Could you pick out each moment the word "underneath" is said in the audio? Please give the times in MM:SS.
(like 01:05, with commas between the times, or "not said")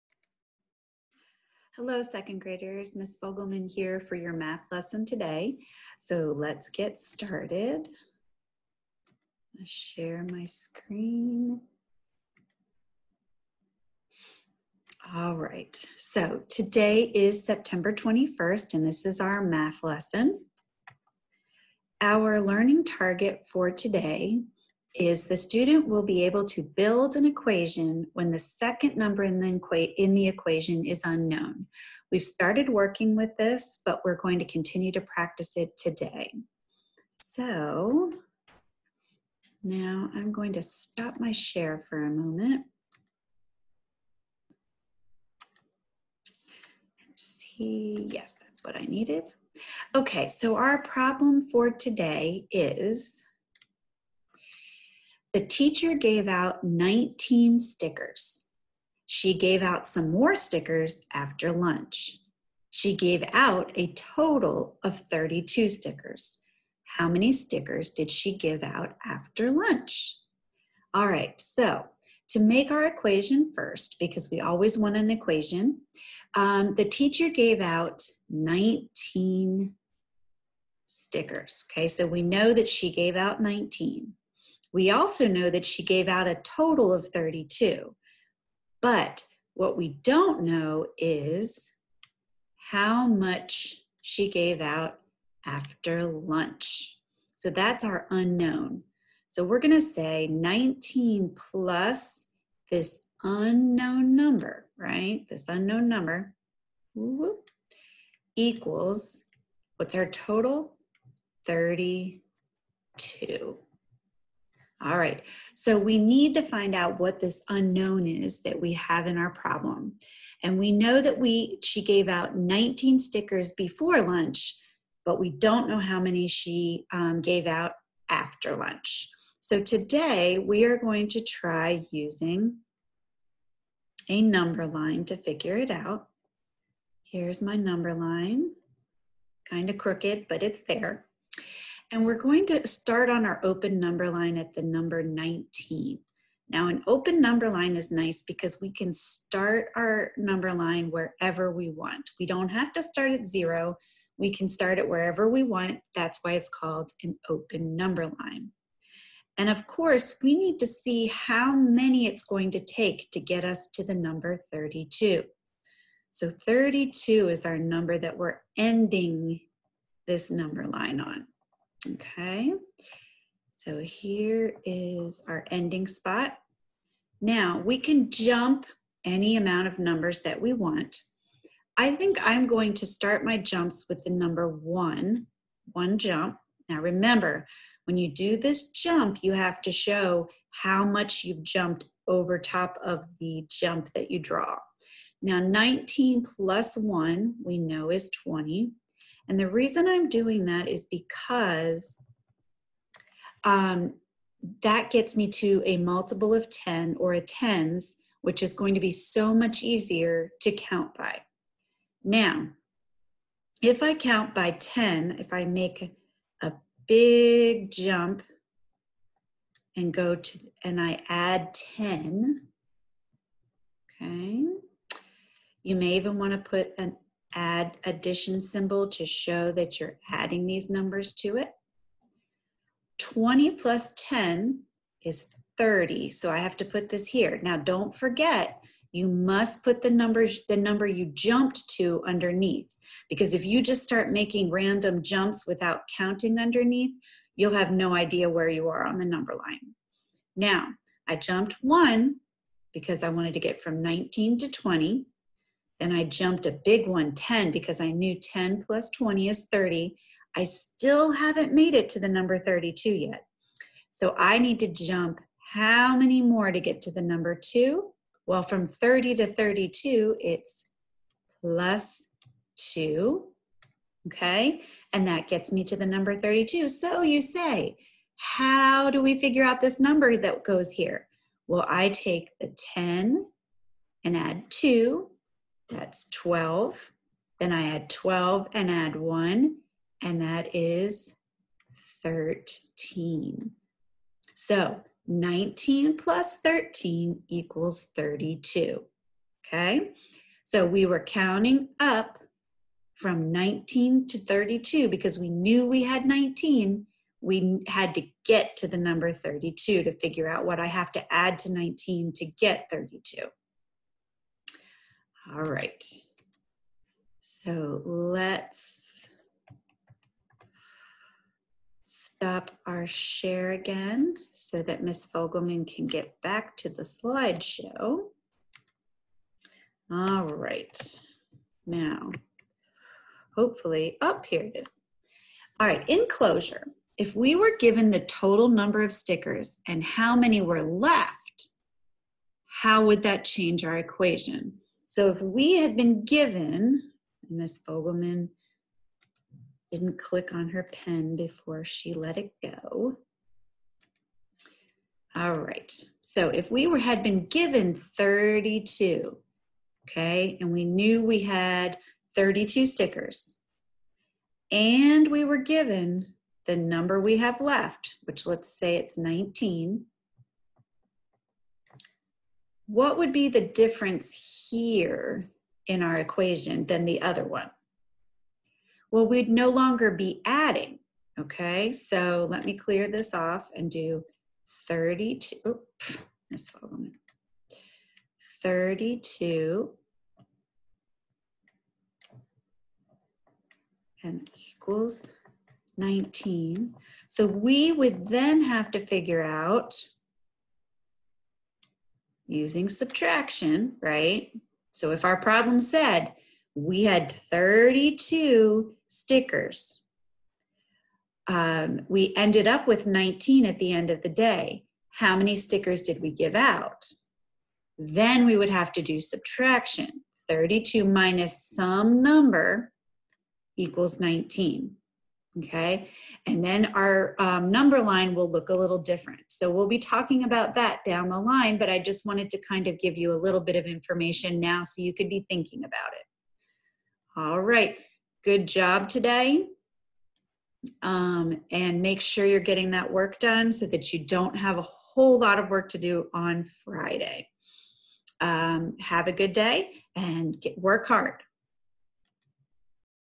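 04:02, 04:06.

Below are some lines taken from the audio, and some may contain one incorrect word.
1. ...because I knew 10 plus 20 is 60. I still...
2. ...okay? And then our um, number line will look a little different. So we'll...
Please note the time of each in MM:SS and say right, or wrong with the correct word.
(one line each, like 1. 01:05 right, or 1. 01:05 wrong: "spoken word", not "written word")
1. 04:17 wrong: "30", not "60"
2. 07:05 right.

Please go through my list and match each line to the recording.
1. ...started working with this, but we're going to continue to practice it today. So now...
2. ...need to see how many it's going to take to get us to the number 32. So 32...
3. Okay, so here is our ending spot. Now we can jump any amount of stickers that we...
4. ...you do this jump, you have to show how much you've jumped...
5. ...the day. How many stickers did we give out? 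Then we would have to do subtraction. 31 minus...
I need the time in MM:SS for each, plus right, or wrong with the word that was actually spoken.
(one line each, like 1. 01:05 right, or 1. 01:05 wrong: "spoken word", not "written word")
1. 00:32 right
2. 02:40 right
3. 02:51 wrong: "numbers", not "stickers"
4. 03:07 right
5. 06:54 wrong: "32", not "31".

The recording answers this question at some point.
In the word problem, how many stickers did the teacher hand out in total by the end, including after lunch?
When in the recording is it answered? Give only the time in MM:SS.
01:02.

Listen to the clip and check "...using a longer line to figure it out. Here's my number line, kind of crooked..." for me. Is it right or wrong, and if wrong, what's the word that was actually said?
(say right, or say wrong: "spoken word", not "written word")
wrong: "number", not "longer".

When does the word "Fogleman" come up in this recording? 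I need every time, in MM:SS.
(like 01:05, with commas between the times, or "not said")
00:03, 05:25, 05:47.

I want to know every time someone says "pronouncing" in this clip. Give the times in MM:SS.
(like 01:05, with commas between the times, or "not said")
not said.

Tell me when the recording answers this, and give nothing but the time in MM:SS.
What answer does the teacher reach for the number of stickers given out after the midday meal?
04:50.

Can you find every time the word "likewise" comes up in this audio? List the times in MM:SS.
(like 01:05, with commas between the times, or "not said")
not said.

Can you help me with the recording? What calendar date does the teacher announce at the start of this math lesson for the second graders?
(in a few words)
September 21st.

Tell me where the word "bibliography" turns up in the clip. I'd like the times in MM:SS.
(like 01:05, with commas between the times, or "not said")
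not said.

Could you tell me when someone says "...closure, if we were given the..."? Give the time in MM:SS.
05:36.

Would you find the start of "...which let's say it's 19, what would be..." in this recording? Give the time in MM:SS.
06:08.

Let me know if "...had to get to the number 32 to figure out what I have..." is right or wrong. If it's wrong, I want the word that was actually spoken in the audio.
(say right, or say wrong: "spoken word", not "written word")
right.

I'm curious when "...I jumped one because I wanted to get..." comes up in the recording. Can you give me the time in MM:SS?
04:11.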